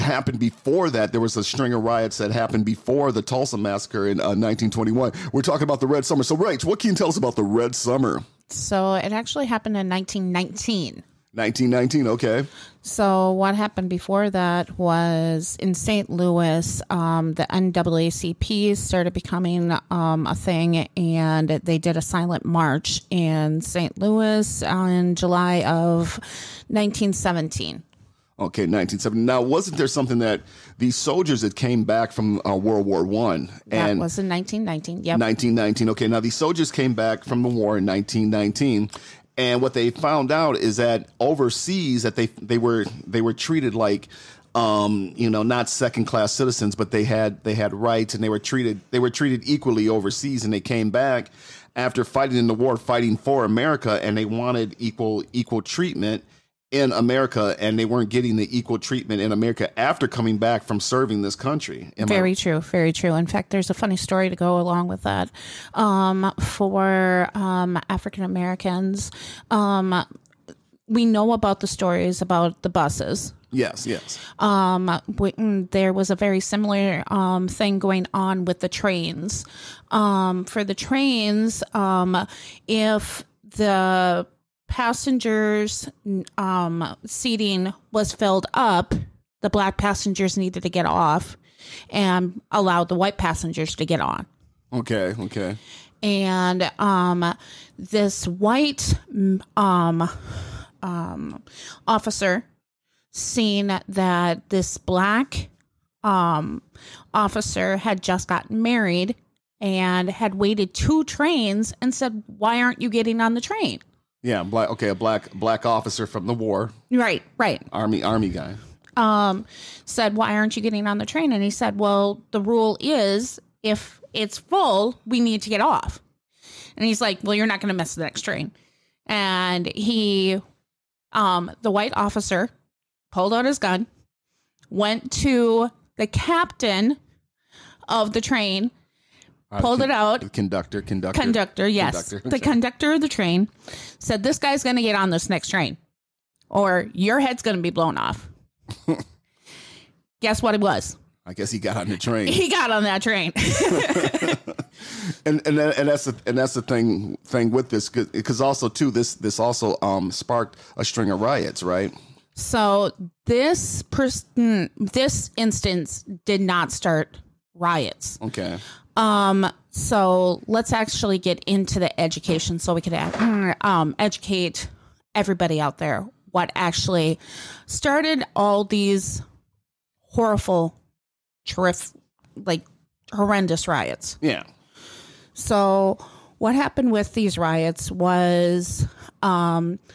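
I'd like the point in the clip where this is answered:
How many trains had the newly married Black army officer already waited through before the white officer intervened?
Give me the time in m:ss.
1:50.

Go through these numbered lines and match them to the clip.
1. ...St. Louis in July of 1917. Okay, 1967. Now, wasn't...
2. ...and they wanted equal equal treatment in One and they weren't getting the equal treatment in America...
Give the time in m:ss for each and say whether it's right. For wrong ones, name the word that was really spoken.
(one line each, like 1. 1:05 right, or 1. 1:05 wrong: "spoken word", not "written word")
1. 0:23 wrong: "1970", not "1967"
2. 0:54 wrong: "America", not "One".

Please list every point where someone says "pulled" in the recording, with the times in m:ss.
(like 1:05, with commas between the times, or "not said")
2:13, 2:19.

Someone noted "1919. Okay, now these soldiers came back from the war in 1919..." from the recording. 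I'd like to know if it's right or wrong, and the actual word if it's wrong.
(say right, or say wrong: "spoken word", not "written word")
right.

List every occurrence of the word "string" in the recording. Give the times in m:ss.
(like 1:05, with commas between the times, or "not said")
0:01, 2:40.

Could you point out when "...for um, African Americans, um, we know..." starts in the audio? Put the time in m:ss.
1:06.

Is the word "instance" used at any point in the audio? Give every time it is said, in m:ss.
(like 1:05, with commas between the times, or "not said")
2:45.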